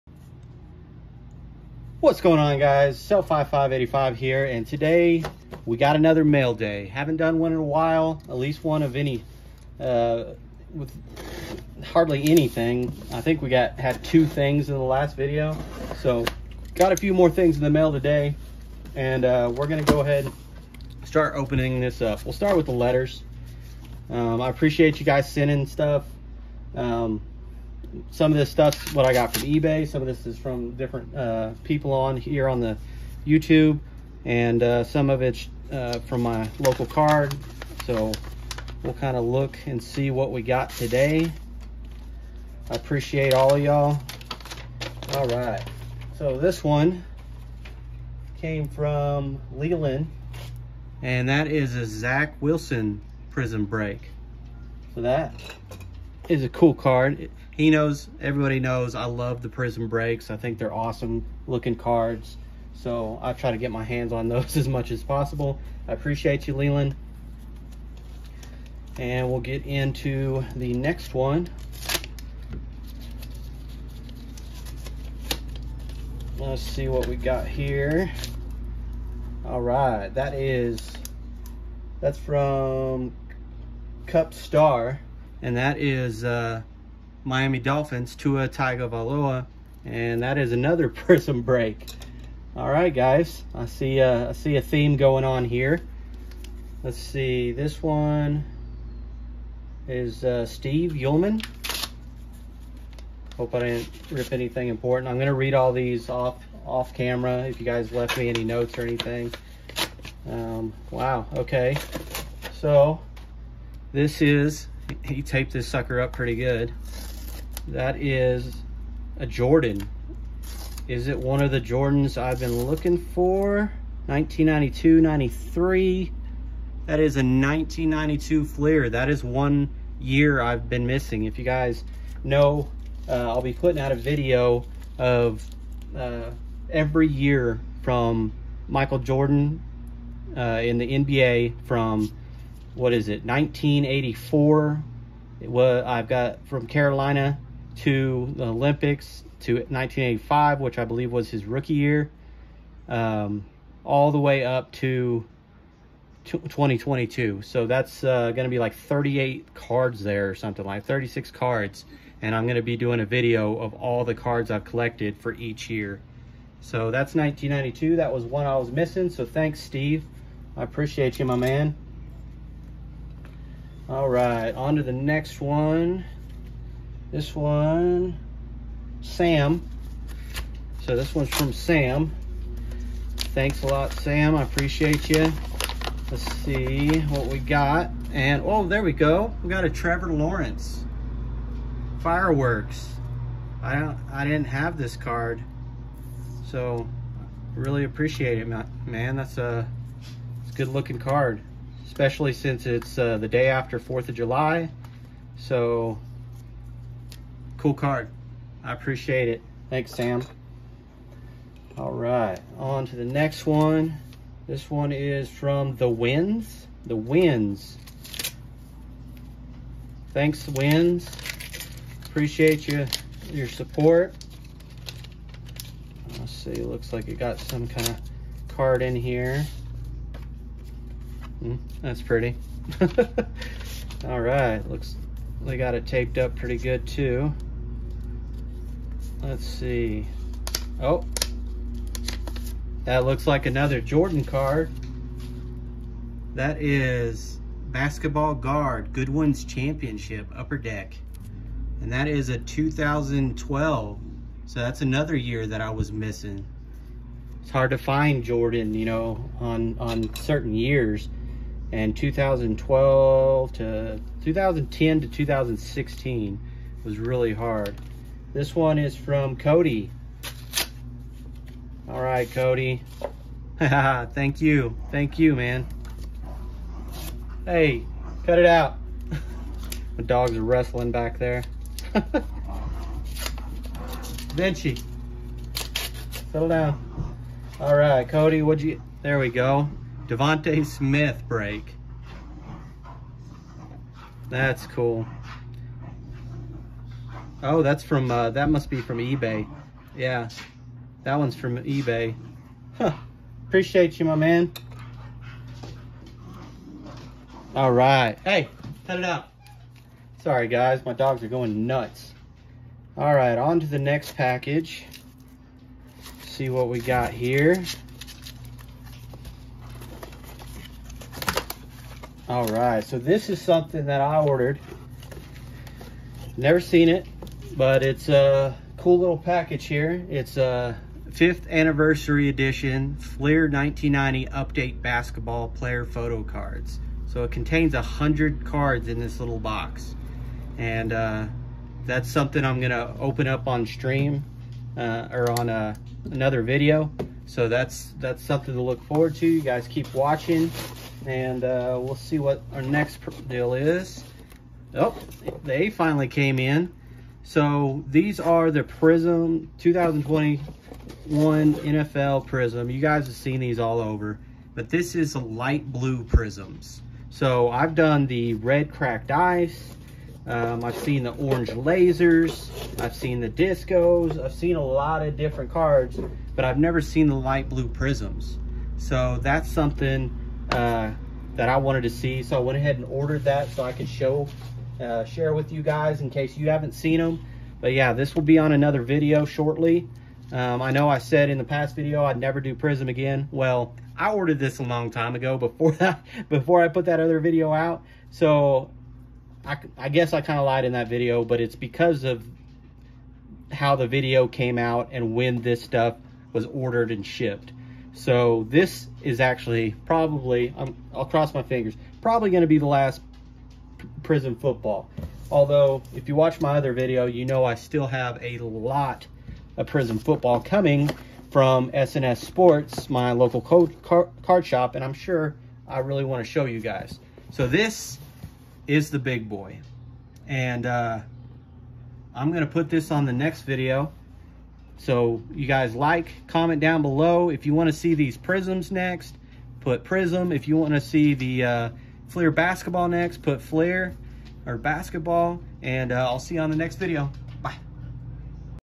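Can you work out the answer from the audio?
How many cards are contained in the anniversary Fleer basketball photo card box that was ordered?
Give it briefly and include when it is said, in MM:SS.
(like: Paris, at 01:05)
100, at 05:37.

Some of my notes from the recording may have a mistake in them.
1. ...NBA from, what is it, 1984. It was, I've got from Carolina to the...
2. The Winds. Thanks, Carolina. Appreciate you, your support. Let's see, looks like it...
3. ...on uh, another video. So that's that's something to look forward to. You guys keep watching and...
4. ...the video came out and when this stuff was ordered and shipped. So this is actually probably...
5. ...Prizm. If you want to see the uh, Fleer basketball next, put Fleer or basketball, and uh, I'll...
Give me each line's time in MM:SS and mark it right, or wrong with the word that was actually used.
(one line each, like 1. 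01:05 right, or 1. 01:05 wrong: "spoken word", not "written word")
1. 02:20 right
2. 03:36 wrong: "Winds", not "Carolina"
3. 05:45 right
4. 06:43 right
5. 07:19 right.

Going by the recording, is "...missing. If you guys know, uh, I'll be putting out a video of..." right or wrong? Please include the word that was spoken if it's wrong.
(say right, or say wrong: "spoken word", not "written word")
right.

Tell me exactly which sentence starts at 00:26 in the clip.
Um, some of this stuff's what I got from eBay.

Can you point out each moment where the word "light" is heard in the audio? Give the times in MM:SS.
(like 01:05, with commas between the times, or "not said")
06:05, 06:17.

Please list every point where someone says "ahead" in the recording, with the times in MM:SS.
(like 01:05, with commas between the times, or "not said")
00:19, 06:22.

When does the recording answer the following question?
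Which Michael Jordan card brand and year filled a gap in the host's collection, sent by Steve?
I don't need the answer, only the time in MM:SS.
02:07.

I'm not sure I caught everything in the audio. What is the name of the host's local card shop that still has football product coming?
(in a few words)
SNS Sports.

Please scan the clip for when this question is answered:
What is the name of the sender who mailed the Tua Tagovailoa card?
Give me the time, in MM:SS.
01:24.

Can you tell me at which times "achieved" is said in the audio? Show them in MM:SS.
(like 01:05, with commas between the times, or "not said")
not said.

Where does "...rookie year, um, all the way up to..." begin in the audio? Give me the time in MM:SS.
02:31.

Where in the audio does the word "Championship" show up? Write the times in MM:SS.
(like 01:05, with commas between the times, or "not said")
04:09.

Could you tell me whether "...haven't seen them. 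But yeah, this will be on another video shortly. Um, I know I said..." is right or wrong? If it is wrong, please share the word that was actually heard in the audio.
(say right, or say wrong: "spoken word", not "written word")
right.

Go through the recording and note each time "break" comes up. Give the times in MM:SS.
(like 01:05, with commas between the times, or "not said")
00:53, 00:59, 01:31, 04:51.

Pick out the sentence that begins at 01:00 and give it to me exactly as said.
I think they're awesome looking cards.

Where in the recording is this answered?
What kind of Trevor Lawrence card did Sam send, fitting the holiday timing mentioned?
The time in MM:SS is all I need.
03:11.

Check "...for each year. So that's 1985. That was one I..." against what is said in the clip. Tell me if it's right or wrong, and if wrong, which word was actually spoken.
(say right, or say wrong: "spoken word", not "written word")
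wrong: "1992", not "1985".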